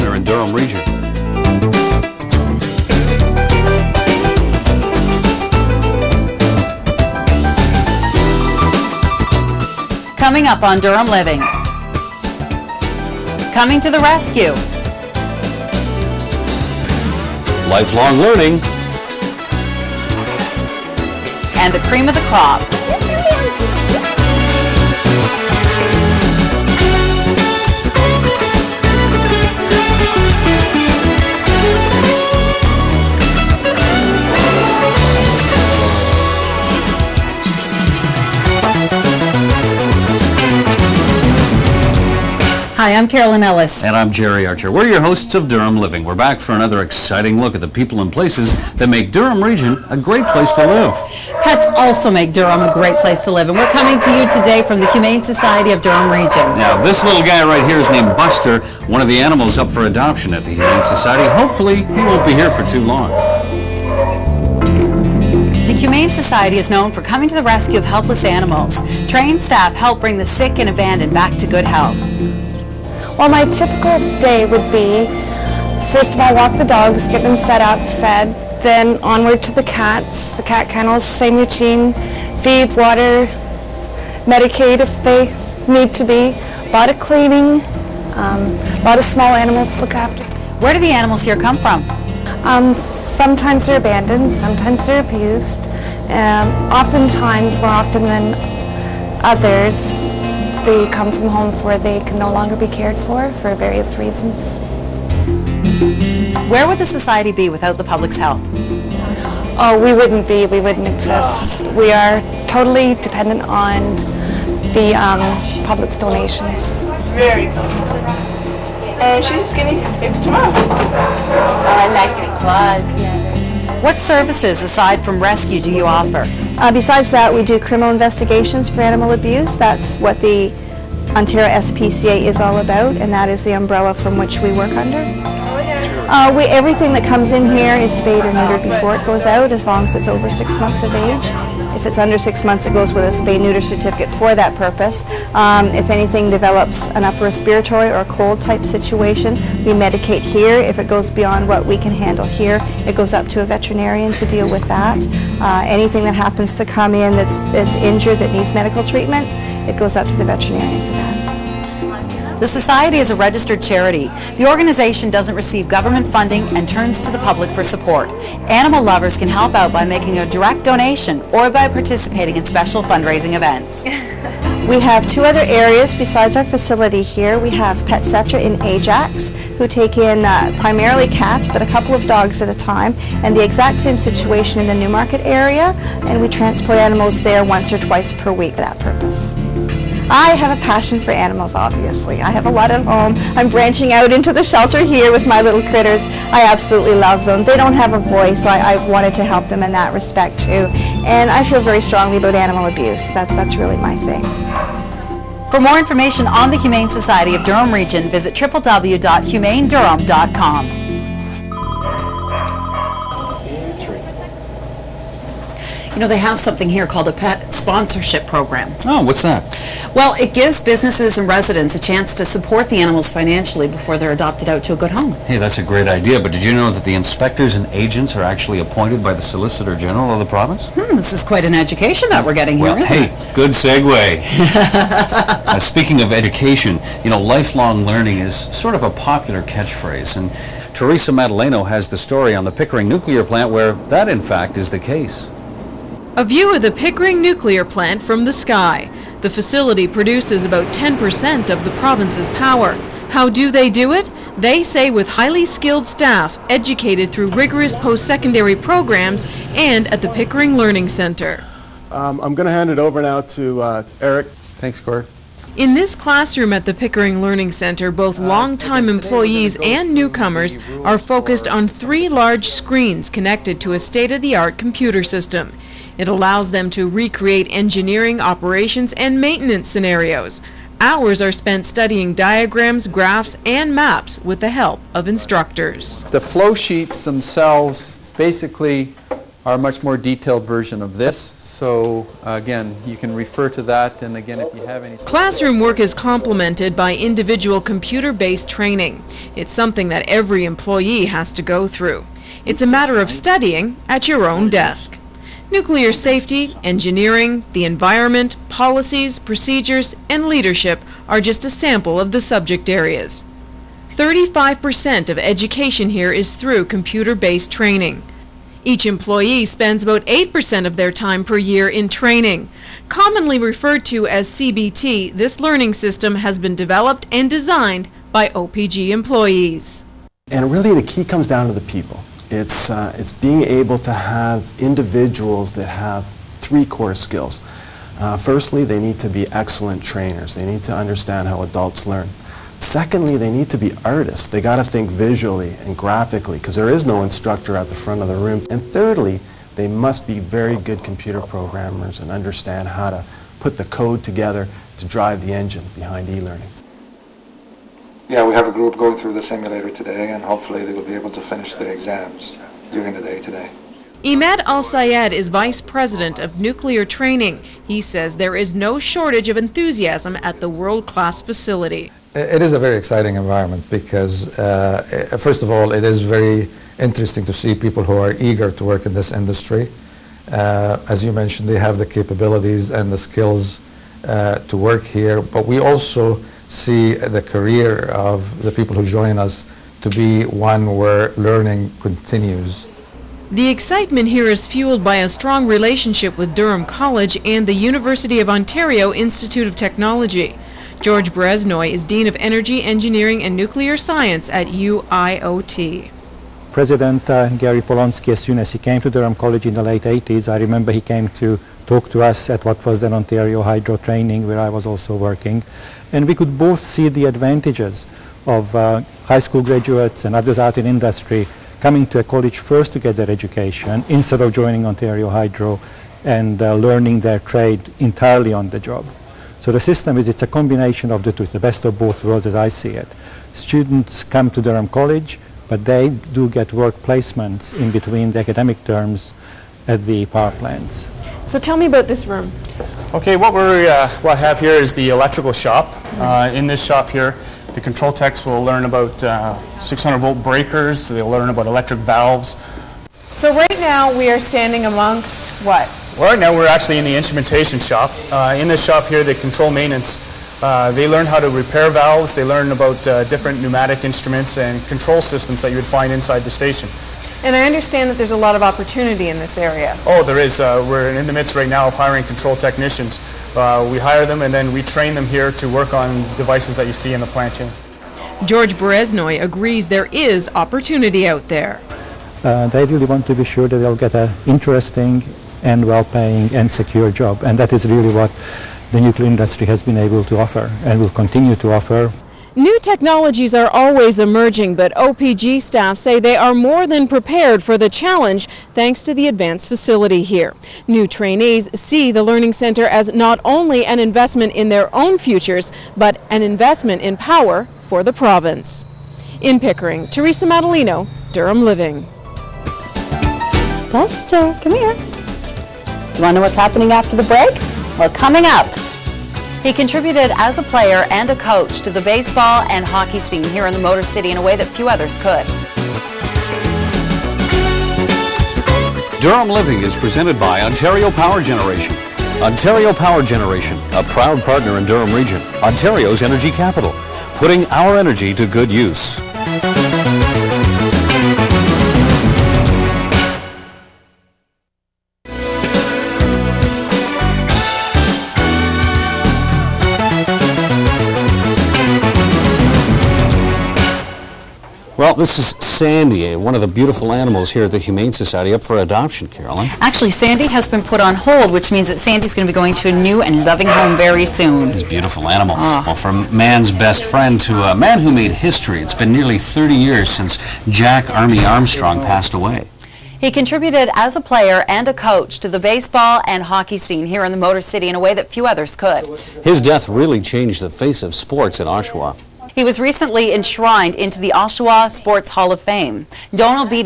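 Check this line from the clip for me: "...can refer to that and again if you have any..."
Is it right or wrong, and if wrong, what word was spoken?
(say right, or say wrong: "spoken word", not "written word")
right.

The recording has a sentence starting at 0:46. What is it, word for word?
We're back for another exciting look at the people and places that make Durham Region a great place to live.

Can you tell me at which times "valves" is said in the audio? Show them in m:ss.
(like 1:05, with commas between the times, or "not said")
7:31, 7:41.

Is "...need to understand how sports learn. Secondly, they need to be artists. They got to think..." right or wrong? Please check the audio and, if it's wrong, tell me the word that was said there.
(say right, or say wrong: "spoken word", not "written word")
wrong: "adults", not "sports".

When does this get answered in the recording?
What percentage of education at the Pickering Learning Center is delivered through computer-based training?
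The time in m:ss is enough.
5:13.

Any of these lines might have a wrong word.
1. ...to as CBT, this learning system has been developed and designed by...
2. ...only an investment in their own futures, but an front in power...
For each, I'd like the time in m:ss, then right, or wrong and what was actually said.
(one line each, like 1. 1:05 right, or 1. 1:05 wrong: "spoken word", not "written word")
1. 5:23 right
2. 8:23 wrong: "investment", not "front".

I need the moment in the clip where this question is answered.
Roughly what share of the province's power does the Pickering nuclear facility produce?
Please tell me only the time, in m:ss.
4:10.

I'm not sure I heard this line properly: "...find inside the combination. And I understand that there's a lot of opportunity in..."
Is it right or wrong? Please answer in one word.
wrong.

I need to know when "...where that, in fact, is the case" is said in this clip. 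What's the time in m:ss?
4:03.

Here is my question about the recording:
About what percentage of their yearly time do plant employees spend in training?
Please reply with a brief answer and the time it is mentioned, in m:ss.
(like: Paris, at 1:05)
8%, at 5:20.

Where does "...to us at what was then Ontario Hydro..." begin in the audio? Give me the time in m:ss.
6:51.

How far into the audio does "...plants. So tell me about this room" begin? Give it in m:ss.
7:20.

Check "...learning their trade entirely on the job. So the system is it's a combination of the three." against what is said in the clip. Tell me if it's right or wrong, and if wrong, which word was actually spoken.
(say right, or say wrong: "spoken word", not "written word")
wrong: "two", not "three".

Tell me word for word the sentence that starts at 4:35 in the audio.
It allows them to recreate engineering, operations, and maintenance scenarios.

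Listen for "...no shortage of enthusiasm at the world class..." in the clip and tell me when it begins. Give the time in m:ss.
6:08.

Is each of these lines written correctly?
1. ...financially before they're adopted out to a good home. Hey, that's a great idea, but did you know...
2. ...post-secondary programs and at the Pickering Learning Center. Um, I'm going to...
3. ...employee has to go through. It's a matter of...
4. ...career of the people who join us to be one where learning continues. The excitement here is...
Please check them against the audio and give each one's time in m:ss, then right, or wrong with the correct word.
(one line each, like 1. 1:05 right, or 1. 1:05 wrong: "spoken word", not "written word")
1. 3:43 right
2. 4:17 right
3. 5:00 right
4. 6:27 right.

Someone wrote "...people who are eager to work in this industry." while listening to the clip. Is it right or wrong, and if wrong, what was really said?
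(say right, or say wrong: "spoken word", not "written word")
right.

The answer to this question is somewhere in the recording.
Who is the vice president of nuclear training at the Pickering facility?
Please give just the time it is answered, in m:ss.
6:04.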